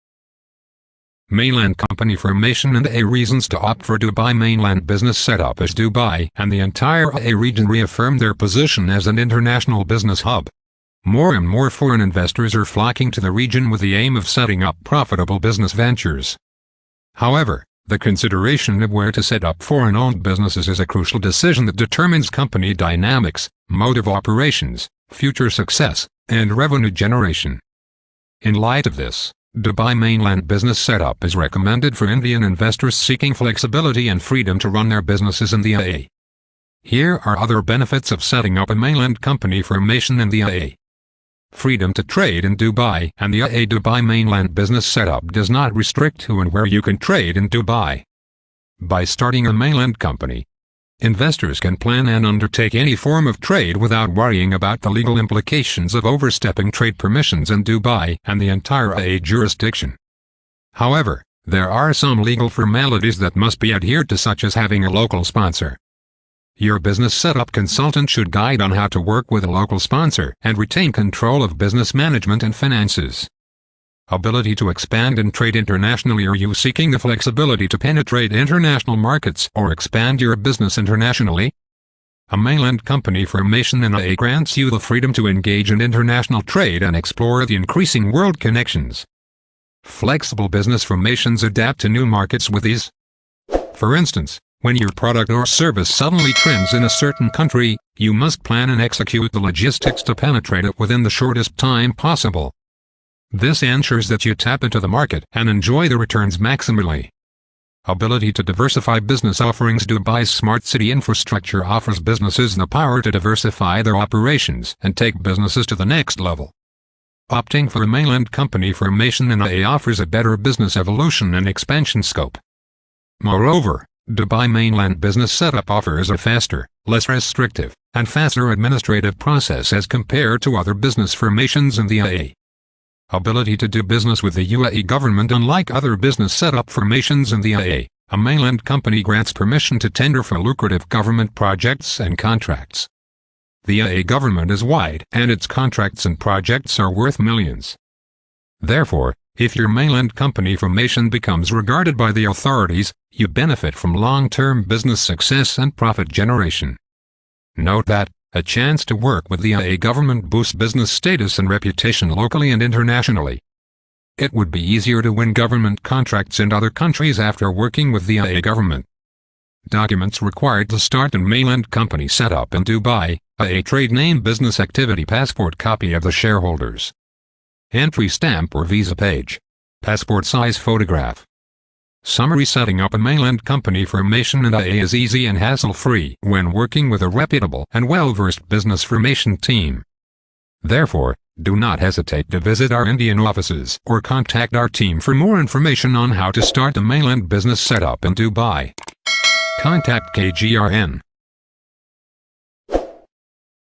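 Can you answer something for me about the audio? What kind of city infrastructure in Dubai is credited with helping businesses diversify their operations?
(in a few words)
Smart city.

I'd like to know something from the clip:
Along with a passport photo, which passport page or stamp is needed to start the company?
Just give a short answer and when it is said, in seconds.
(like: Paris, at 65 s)
Entry stamp or visa page, at 177 s.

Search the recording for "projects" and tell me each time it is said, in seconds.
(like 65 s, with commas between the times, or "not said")
141 s, 146 s.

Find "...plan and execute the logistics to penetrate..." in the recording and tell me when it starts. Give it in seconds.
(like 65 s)
98 s.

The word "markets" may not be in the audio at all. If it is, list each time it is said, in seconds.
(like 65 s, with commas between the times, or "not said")
78 s, 92 s, 104 s.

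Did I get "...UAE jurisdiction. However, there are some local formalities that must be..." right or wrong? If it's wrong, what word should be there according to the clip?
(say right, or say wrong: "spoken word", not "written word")
wrong: "legal", not "local".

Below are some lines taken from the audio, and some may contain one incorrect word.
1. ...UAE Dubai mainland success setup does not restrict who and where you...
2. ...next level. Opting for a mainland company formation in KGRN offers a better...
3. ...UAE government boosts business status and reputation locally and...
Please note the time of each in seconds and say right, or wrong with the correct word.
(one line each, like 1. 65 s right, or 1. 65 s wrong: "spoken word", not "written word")
1. 43 s wrong: "business", not "success"
2. 115 s wrong: "UAE", not "KGRN"
3. 159 s right.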